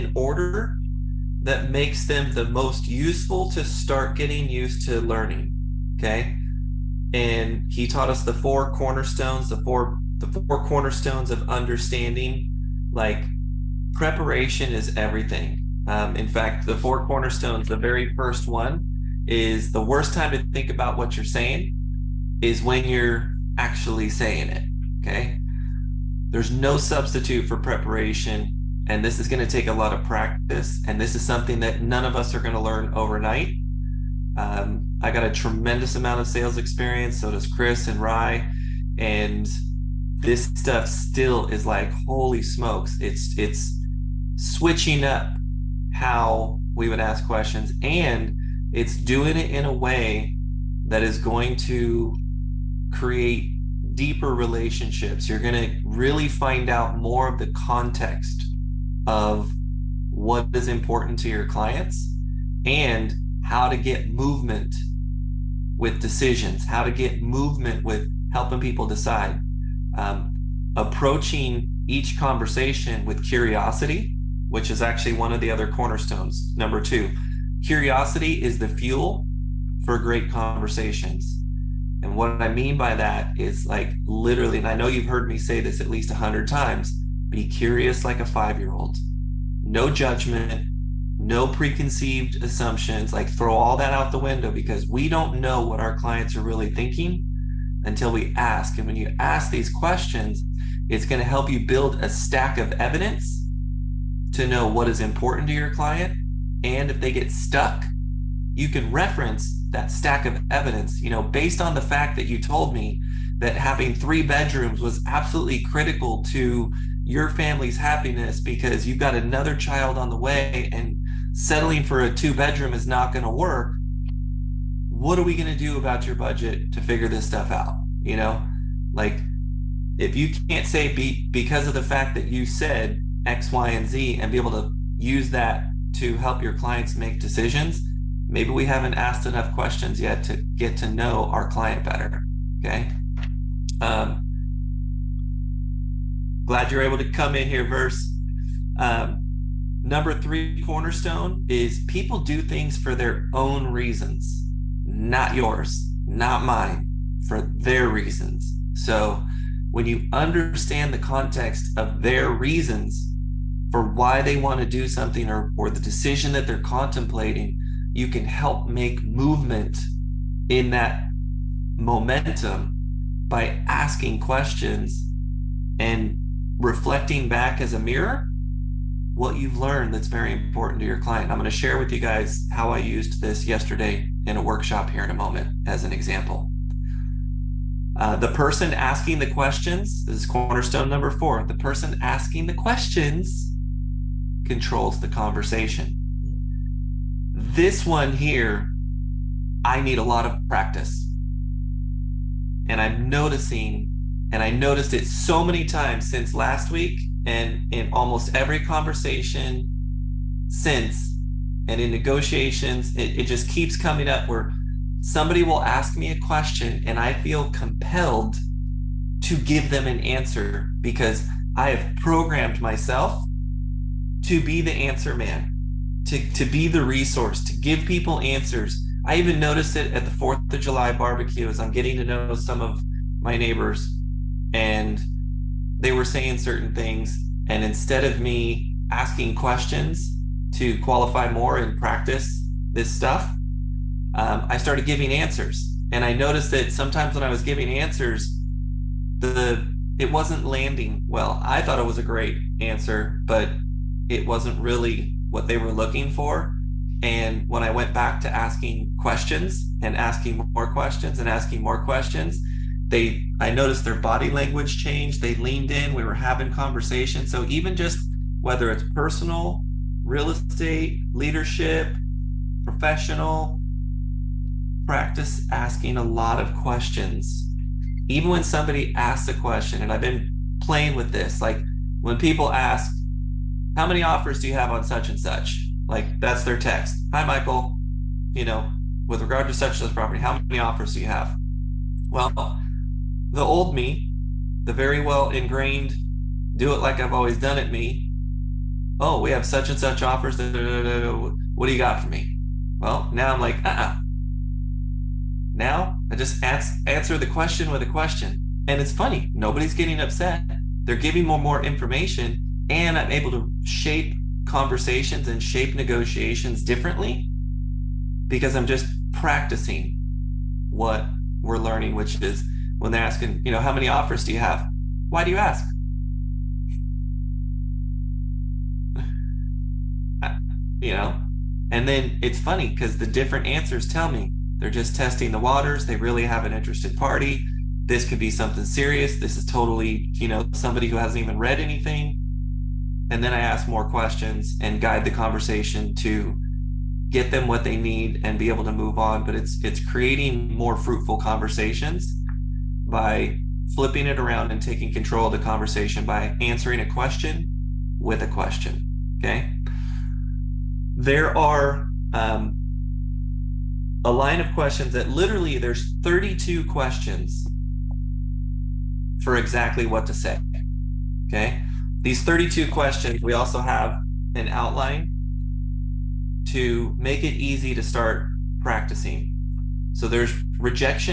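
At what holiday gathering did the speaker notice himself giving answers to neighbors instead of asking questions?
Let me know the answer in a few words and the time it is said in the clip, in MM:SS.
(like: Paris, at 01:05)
4th of July barbecue, at 03:50.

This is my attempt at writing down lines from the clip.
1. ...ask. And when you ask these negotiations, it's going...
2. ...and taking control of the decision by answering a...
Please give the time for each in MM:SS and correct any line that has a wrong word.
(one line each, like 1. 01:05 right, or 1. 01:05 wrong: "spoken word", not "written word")
1. 01:38 wrong: "questions", not "negotiations"
2. 05:54 wrong: "conversation", not "decision".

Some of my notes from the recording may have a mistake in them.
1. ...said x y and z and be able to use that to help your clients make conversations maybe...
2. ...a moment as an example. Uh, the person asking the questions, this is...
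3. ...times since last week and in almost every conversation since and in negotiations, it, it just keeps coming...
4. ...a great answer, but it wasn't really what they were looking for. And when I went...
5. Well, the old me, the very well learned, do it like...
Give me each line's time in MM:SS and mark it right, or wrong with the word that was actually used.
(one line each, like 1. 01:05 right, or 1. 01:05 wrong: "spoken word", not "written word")
1. 02:12 wrong: "decisions", not "conversations"
2. 03:05 right
3. 03:25 right
4. 04:11 right
5. 04:52 wrong: "ingrained", not "learned".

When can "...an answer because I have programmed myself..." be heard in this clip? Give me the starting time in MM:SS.
03:39.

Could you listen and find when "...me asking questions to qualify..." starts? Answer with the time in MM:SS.
03:58.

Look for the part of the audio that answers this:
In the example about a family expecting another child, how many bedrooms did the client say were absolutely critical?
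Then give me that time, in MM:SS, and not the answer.
01:53.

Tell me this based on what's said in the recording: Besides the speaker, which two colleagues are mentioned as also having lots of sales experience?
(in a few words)
Chris and Rye.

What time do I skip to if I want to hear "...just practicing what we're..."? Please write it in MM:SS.
05:18.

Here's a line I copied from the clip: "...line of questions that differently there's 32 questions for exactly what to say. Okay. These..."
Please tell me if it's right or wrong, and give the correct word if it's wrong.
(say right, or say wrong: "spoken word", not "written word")
wrong: "literally", not "differently".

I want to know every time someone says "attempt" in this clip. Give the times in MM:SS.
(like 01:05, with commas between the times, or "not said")
not said.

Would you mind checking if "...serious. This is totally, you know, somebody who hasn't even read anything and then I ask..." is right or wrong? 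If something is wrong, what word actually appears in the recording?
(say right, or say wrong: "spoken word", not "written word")
right.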